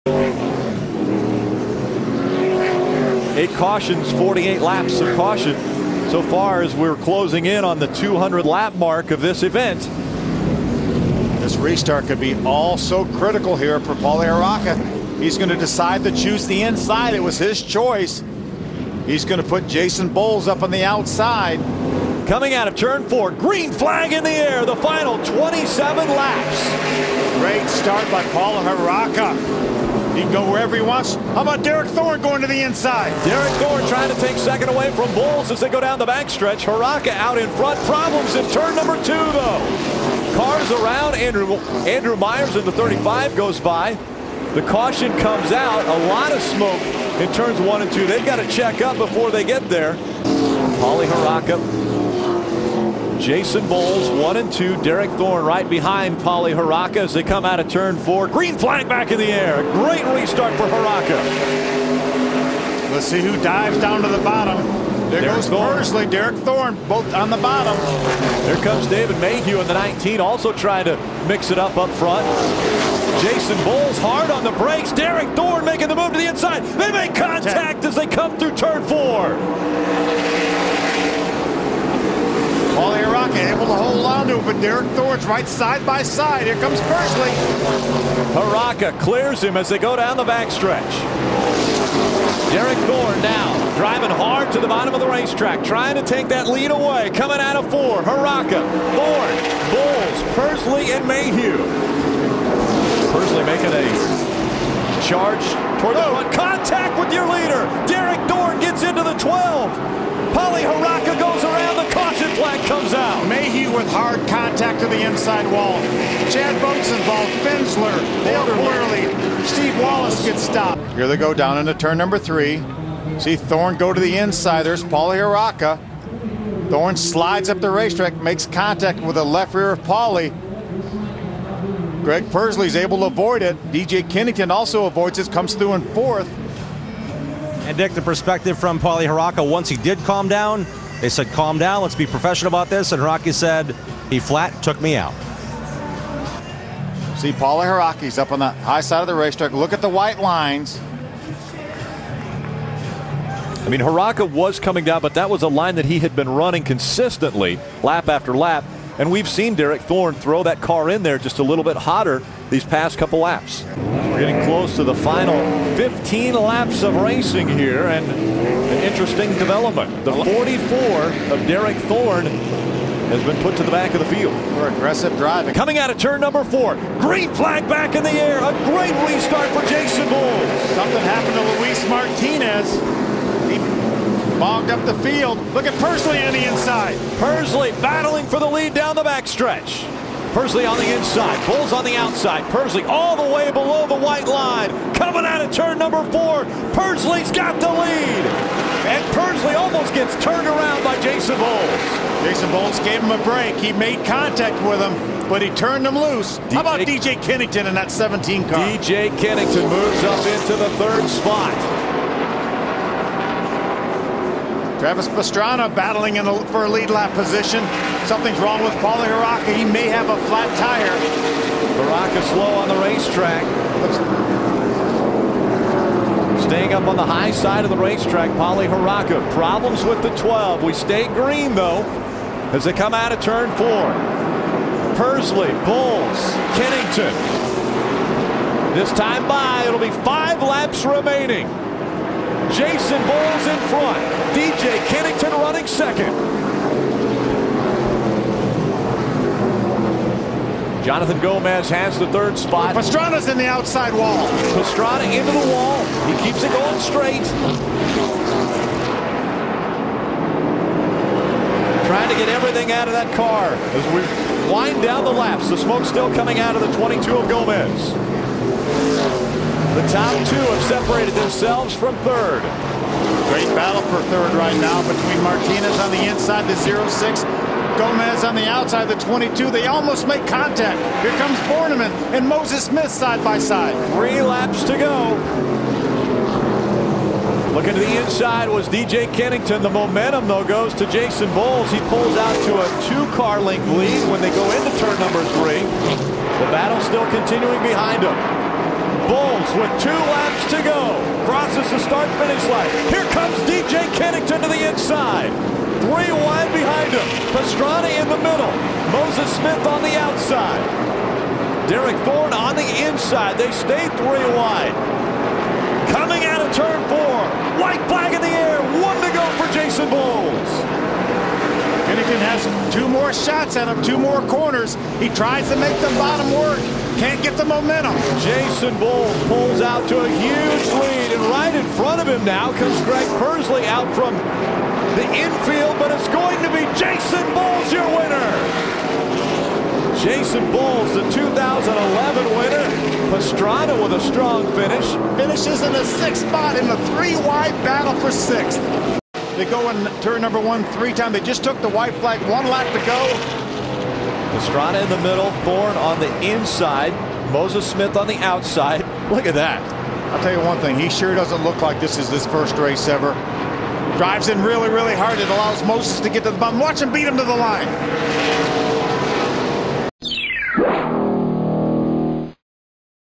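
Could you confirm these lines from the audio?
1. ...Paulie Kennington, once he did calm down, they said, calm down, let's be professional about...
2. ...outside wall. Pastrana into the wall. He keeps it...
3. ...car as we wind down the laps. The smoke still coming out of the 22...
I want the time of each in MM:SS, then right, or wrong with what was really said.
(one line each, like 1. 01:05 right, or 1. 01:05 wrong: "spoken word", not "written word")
1. 02:18 wrong: "Harraka", not "Kennington"
2. 04:13 right
3. 04:23 right.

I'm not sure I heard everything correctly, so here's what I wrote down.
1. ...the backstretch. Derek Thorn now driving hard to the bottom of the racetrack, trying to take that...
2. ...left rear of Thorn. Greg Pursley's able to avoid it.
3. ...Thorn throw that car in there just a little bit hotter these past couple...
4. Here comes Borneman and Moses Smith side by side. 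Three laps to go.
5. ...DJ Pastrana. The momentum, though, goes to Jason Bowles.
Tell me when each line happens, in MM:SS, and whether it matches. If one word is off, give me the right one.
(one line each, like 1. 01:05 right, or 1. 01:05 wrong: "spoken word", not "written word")
1. 01:30 right
2. 02:09 wrong: "Paulie", not "Thorn"
3. 02:39 right
4. 04:41 right
5. 04:48 wrong: "Kennington", not "Pastrana".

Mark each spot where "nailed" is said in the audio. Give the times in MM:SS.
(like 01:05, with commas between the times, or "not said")
01:58.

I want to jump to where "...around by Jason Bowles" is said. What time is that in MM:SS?
03:20.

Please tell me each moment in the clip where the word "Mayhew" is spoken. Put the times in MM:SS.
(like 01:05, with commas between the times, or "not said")
01:09, 01:41, 01:53.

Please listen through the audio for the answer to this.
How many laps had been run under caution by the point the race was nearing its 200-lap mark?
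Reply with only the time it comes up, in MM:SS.
00:04.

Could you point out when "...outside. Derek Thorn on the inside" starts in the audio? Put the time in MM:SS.
05:09.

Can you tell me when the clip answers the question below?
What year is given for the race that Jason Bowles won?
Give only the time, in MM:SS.
05:41.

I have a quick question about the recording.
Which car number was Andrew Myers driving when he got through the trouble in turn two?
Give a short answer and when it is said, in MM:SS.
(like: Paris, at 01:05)
35, at 00:42.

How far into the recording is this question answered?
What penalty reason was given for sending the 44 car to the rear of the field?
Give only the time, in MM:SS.
02:54.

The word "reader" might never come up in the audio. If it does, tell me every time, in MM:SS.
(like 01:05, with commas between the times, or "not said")
not said.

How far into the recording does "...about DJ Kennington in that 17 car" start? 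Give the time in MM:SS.
03:26.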